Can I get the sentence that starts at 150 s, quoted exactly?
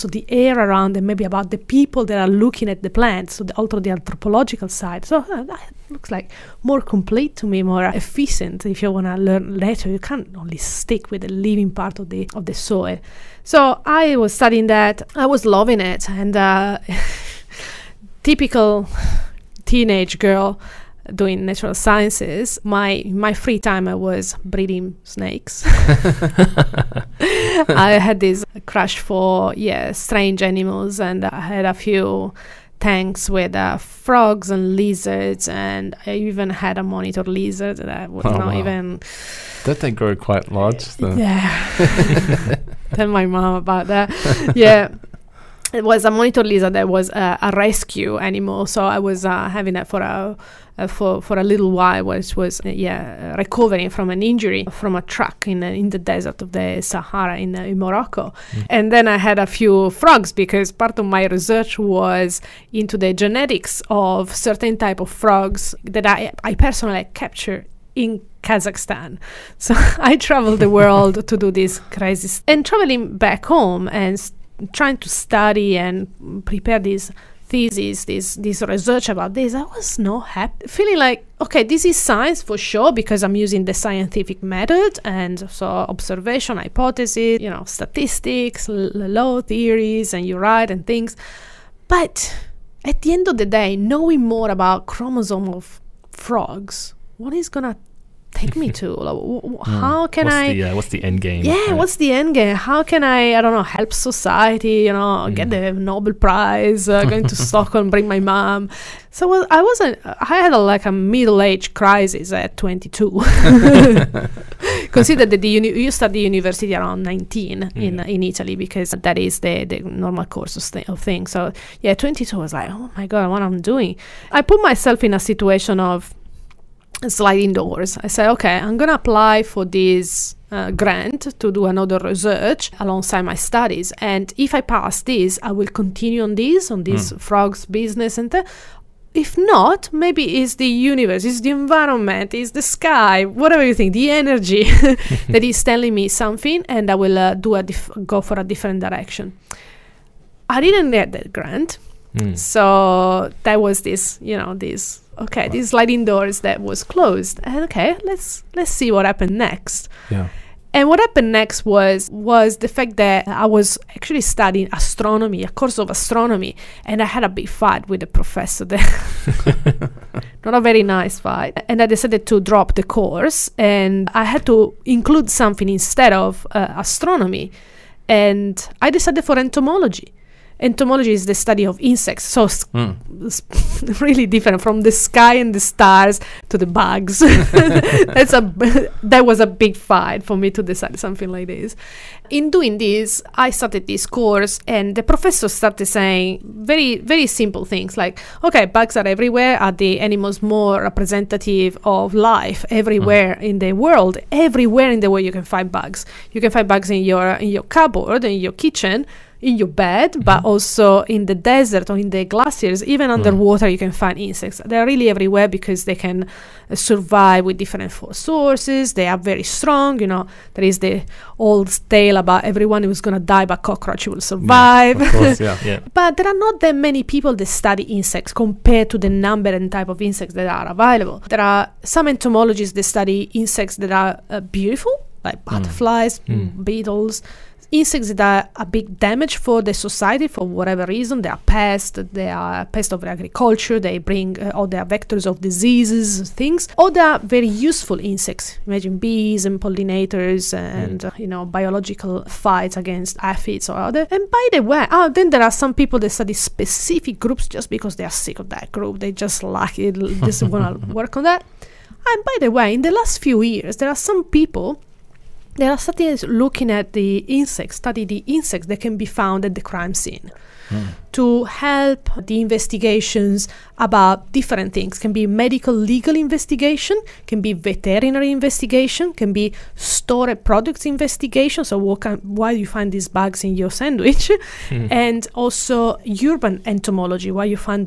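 I didn't get that grant, mm.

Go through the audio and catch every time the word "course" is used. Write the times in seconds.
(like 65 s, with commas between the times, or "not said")
120 s, 165 s, 172 s, 194 s, 225 s.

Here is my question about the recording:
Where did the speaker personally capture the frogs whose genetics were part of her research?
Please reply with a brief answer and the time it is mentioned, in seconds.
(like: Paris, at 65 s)
Kazakhstan, at 68 s.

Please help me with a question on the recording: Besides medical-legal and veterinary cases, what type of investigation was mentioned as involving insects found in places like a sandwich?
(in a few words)
Stored products investigation.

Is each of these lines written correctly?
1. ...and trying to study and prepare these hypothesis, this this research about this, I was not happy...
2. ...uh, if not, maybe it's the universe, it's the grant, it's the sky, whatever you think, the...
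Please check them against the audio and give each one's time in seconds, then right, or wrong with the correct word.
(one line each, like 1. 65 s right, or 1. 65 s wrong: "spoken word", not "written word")
1. 73 s wrong: "thesis", not "hypothesis"
2. 138 s wrong: "environment", not "grant".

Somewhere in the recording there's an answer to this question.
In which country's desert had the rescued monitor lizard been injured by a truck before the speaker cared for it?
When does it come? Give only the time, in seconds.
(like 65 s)
57 s.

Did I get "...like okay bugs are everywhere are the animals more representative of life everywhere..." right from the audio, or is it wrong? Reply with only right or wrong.
right.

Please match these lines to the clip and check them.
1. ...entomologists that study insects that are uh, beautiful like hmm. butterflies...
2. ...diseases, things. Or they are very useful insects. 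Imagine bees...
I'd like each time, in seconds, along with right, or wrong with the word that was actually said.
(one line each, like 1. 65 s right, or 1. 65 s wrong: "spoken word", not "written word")
1. 232 s right
2. 245 s right.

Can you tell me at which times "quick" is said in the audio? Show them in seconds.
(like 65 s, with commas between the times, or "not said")
not said.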